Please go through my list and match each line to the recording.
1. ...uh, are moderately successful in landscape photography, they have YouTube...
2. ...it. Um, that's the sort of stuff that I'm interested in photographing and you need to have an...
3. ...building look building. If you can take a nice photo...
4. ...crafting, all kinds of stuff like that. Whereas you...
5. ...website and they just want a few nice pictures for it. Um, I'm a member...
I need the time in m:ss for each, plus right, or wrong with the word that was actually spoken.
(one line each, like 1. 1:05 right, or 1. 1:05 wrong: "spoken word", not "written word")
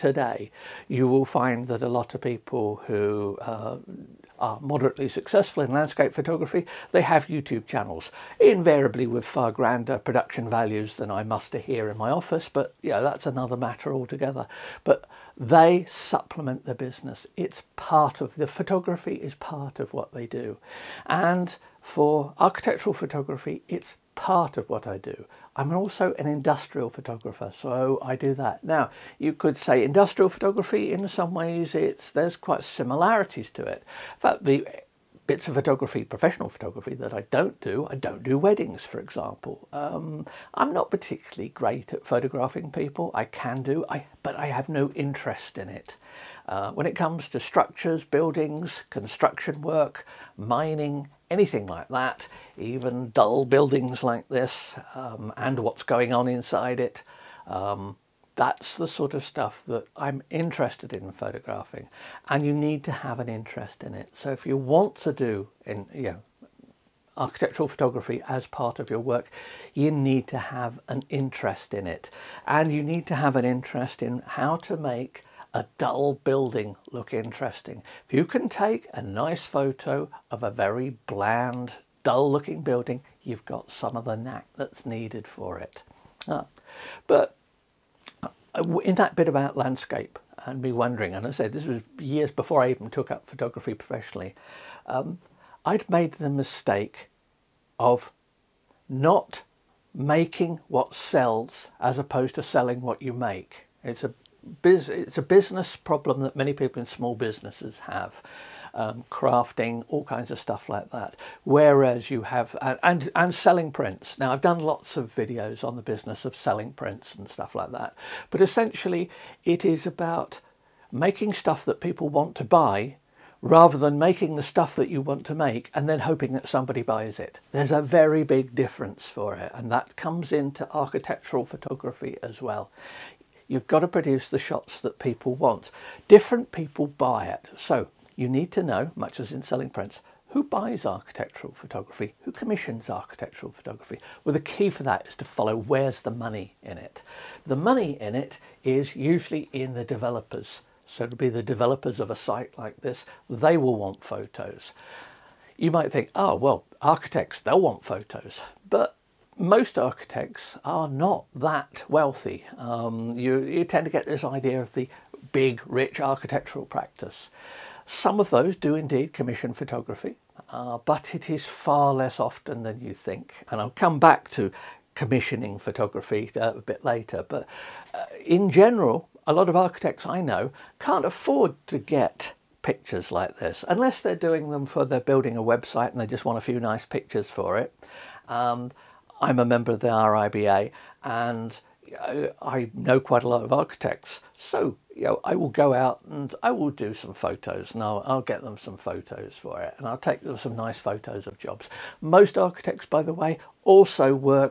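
1. 0:03 right
2. 0:56 right
3. 1:16 wrong: "interesting", not "building"
4. 1:49 right
5. 3:05 right.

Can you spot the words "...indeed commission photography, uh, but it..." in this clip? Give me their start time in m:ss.
2:48.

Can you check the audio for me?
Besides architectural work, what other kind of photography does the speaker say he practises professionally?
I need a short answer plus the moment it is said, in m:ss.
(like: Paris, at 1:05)
Industrial photography, at 0:26.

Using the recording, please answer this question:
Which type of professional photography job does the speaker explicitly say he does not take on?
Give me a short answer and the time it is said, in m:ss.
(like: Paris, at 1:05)
Weddings, at 0:38.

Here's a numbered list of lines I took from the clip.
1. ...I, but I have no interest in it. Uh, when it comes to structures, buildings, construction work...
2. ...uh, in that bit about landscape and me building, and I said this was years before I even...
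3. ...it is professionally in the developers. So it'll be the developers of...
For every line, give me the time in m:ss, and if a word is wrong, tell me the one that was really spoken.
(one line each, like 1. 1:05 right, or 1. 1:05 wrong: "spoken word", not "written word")
1. 0:43 right
2. 1:28 wrong: "wondering", not "building"
3. 2:28 wrong: "usually", not "professionally".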